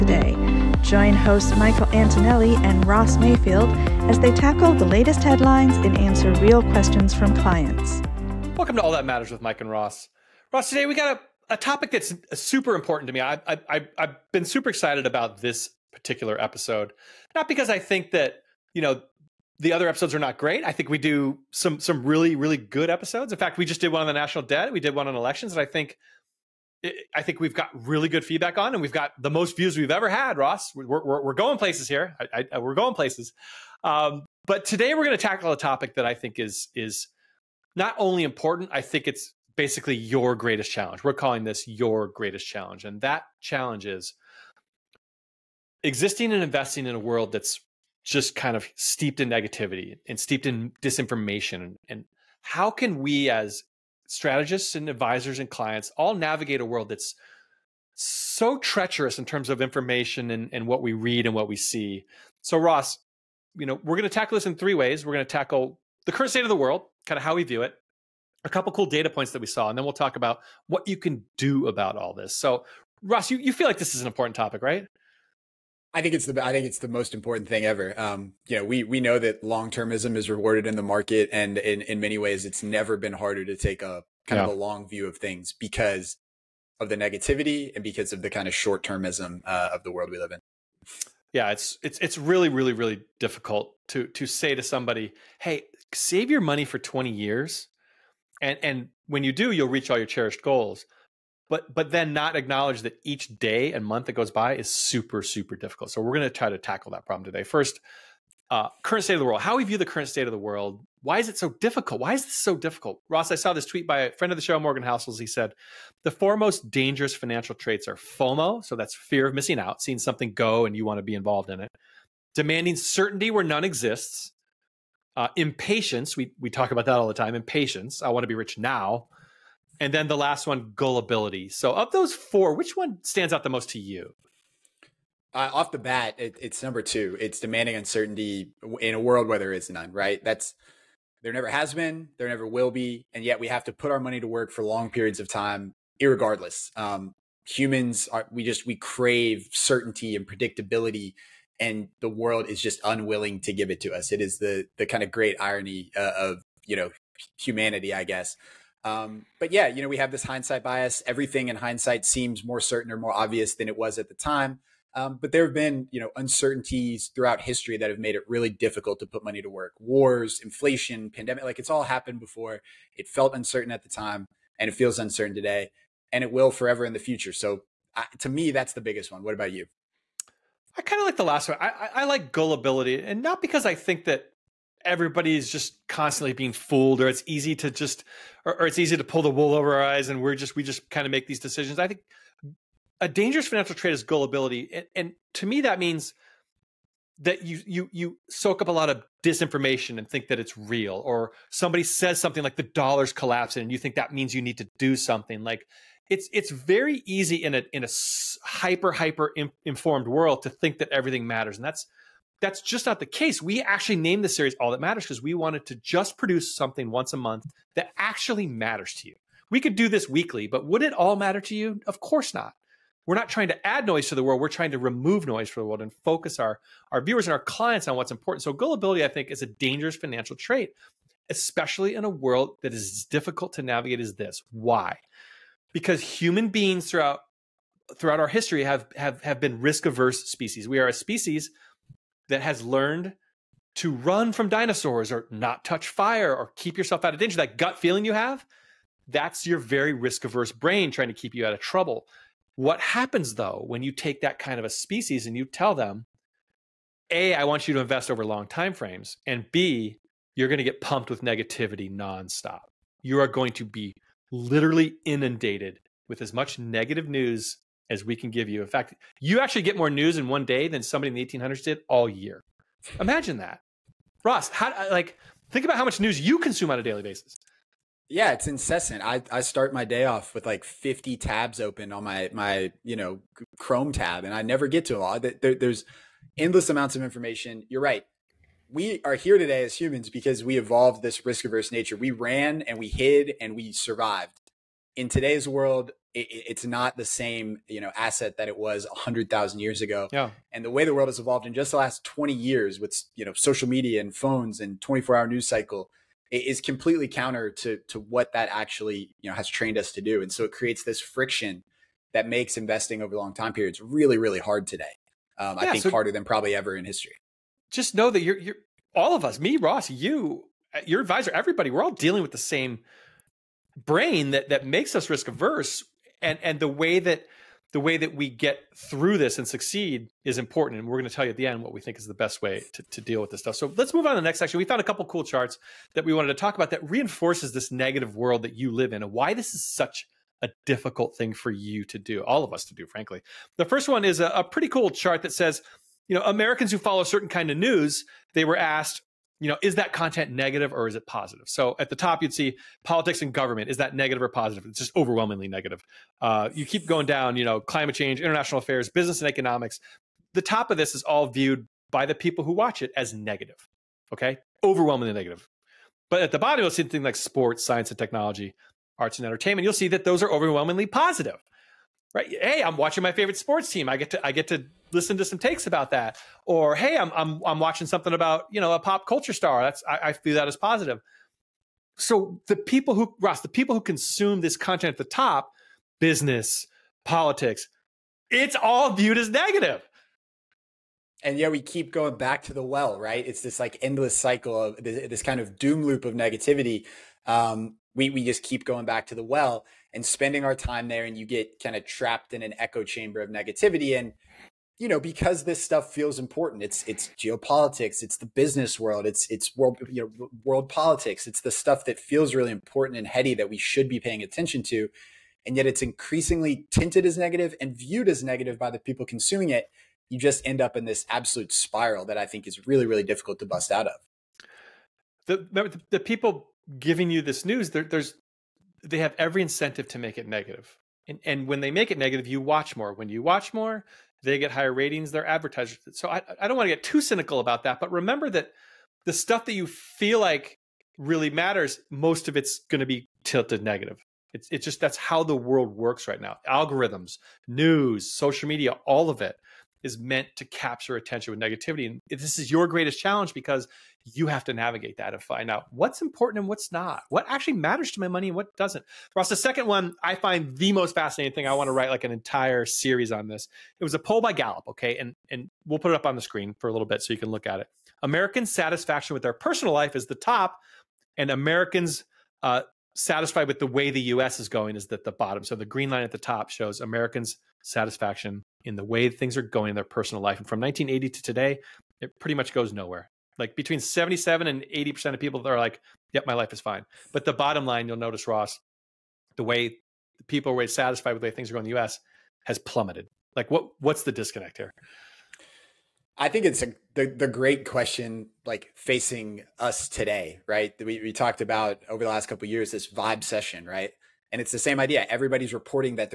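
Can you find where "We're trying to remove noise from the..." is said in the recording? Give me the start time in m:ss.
3:44.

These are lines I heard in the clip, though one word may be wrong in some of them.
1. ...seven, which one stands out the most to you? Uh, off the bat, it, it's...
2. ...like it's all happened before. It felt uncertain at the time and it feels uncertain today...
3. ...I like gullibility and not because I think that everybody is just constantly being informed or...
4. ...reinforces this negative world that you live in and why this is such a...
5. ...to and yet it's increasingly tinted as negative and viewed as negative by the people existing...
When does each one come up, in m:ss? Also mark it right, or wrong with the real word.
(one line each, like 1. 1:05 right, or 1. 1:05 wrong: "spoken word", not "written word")
1. 2:12 wrong: "four", not "seven"
2. 2:51 right
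3. 3:01 wrong: "fooled", not "informed"
4. 5:36 right
5. 6:54 wrong: "consuming", not "existing".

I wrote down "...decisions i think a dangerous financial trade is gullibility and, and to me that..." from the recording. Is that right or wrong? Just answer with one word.
right.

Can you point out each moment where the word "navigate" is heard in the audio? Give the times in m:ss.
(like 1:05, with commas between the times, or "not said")
0:56, 3:53, 7:34.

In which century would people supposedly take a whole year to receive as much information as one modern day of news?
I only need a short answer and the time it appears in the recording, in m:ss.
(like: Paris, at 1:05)
1800s, at 4:31.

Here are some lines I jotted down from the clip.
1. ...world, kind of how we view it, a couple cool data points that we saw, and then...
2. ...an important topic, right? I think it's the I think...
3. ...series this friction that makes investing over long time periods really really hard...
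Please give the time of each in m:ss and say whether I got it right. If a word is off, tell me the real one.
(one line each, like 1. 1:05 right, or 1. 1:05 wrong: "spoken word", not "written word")
1. 1:06 right
2. 1:14 right
3. 5:10 wrong: "creates", not "series".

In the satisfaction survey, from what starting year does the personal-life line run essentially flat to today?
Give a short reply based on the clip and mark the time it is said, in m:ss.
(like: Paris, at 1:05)
1980, at 8:00.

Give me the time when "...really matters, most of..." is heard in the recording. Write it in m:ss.
7:20.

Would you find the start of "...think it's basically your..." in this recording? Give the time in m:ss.
0:38.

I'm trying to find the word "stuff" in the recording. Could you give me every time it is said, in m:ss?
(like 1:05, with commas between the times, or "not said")
5:33, 6:45, 6:51, 7:19.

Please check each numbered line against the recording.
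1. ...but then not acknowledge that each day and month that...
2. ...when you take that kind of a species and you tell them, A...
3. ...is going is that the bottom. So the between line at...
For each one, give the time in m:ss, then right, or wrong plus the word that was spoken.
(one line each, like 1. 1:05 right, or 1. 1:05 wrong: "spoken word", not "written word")
1. 1:41 right
2. 4:13 right
3. 7:54 wrong: "green", not "between".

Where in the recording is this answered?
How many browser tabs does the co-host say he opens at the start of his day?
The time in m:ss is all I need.
4:40.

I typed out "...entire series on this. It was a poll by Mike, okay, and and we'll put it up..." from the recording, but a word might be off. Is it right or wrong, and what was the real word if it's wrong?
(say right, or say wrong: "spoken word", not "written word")
wrong: "Gallup", not "Mike".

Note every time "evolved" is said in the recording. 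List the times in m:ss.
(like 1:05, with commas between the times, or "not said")
4:50, 5:01.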